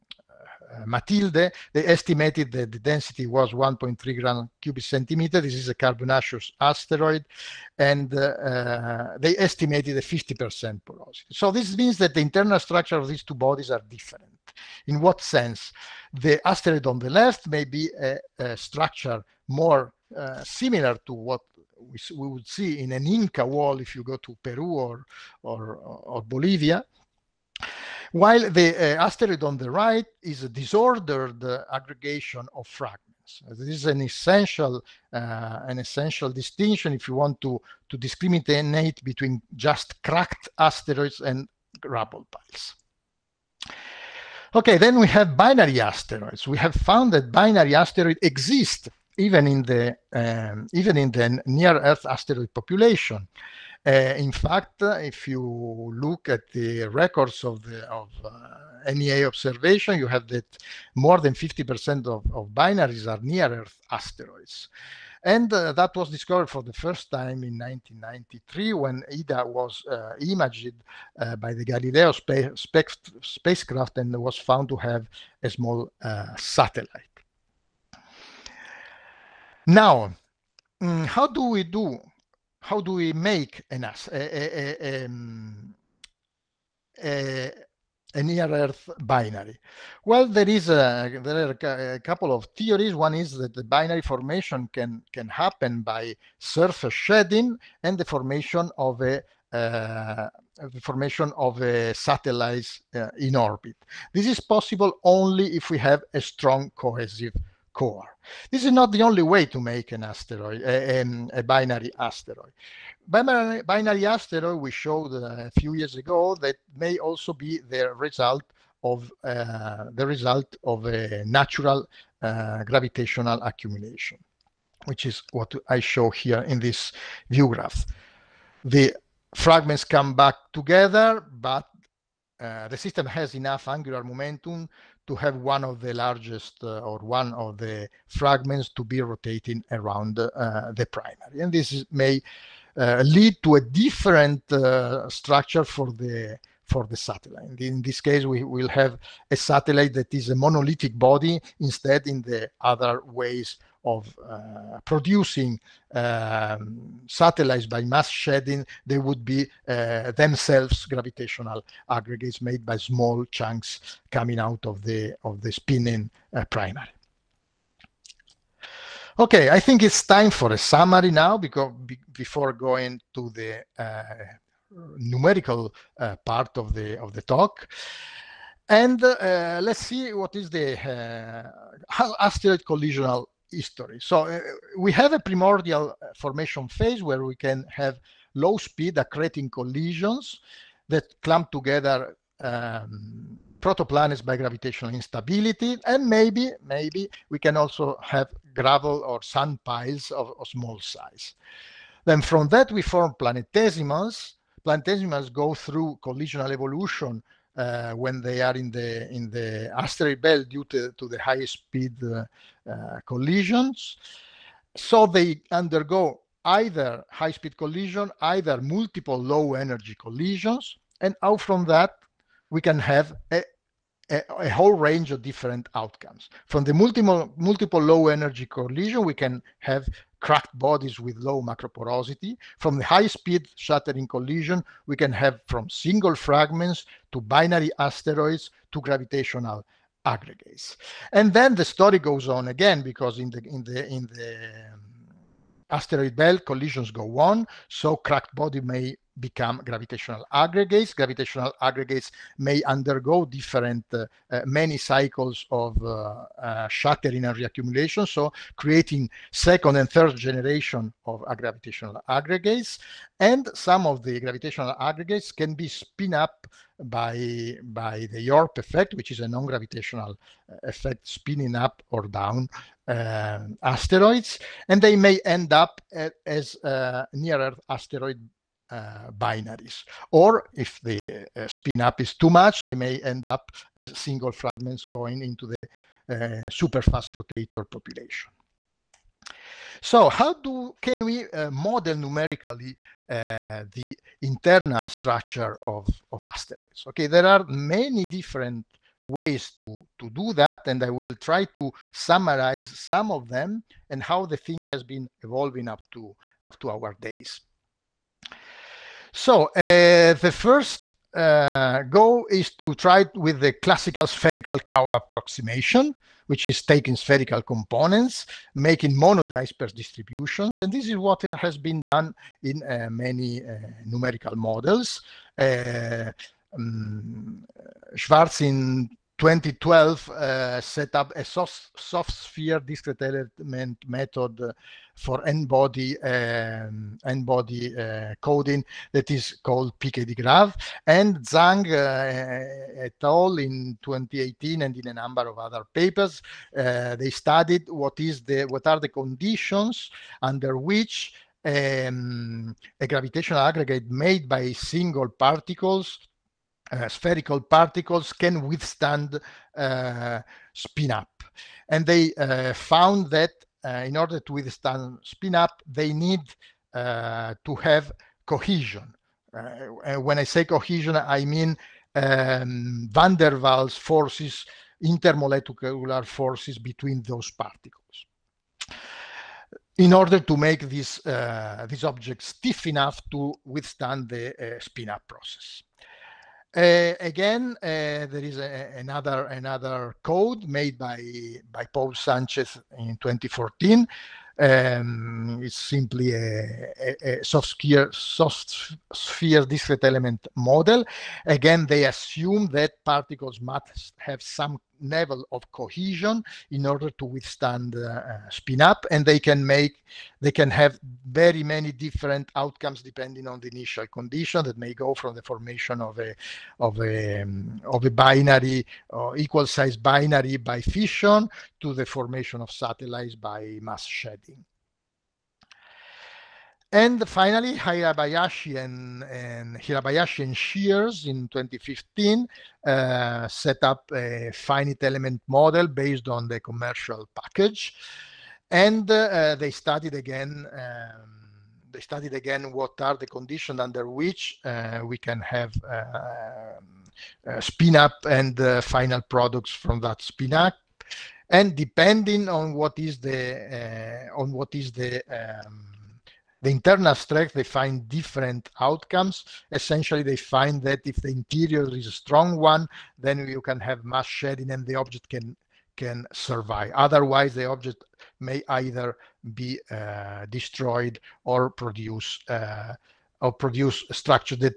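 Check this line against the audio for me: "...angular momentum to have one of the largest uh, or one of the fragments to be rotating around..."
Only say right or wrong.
right.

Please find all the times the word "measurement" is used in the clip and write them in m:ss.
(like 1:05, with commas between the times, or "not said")
not said.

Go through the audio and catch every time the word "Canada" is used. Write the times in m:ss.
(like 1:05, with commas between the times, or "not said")
not said.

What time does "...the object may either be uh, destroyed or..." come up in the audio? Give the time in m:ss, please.
7:47.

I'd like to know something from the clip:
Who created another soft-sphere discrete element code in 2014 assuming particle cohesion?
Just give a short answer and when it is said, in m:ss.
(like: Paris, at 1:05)
Paul Sanchez, at 6:31.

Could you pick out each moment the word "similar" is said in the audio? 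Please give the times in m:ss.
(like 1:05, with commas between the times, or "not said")
0:20.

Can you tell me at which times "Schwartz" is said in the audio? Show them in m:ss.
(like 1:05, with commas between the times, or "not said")
5:27.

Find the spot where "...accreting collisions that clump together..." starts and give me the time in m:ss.
3:08.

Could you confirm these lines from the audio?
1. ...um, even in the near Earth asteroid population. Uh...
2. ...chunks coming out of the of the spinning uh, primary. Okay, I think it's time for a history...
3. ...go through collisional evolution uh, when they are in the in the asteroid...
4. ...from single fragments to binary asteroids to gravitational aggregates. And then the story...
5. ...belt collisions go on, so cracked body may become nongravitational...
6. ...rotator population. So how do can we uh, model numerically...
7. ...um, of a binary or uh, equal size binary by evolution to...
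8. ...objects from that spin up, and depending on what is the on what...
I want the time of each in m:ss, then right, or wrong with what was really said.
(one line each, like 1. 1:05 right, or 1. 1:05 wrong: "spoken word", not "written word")
1. 0:50 right
2. 2:43 wrong: "summary", not "history"
3. 3:25 right
4. 3:55 right
5. 4:06 wrong: "gravitational", not "nongravitational"
6. 4:47 right
7. 6:57 wrong: "fission", not "evolution"
8. 7:28 wrong: "products", not "objects".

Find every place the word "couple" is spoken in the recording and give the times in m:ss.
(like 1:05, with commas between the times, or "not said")
1:31.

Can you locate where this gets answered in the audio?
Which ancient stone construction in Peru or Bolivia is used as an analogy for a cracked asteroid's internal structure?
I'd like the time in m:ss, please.
0:23.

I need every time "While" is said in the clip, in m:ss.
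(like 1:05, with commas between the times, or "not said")
0:28.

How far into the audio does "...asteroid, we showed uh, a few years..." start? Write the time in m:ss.
1:54.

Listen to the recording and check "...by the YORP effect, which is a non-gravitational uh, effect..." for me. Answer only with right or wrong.
right.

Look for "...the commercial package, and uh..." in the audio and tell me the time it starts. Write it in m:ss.
7:16.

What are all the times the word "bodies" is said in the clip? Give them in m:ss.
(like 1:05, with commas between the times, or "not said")
0:13, 3:50.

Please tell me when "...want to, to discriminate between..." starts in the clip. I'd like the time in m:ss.
0:37.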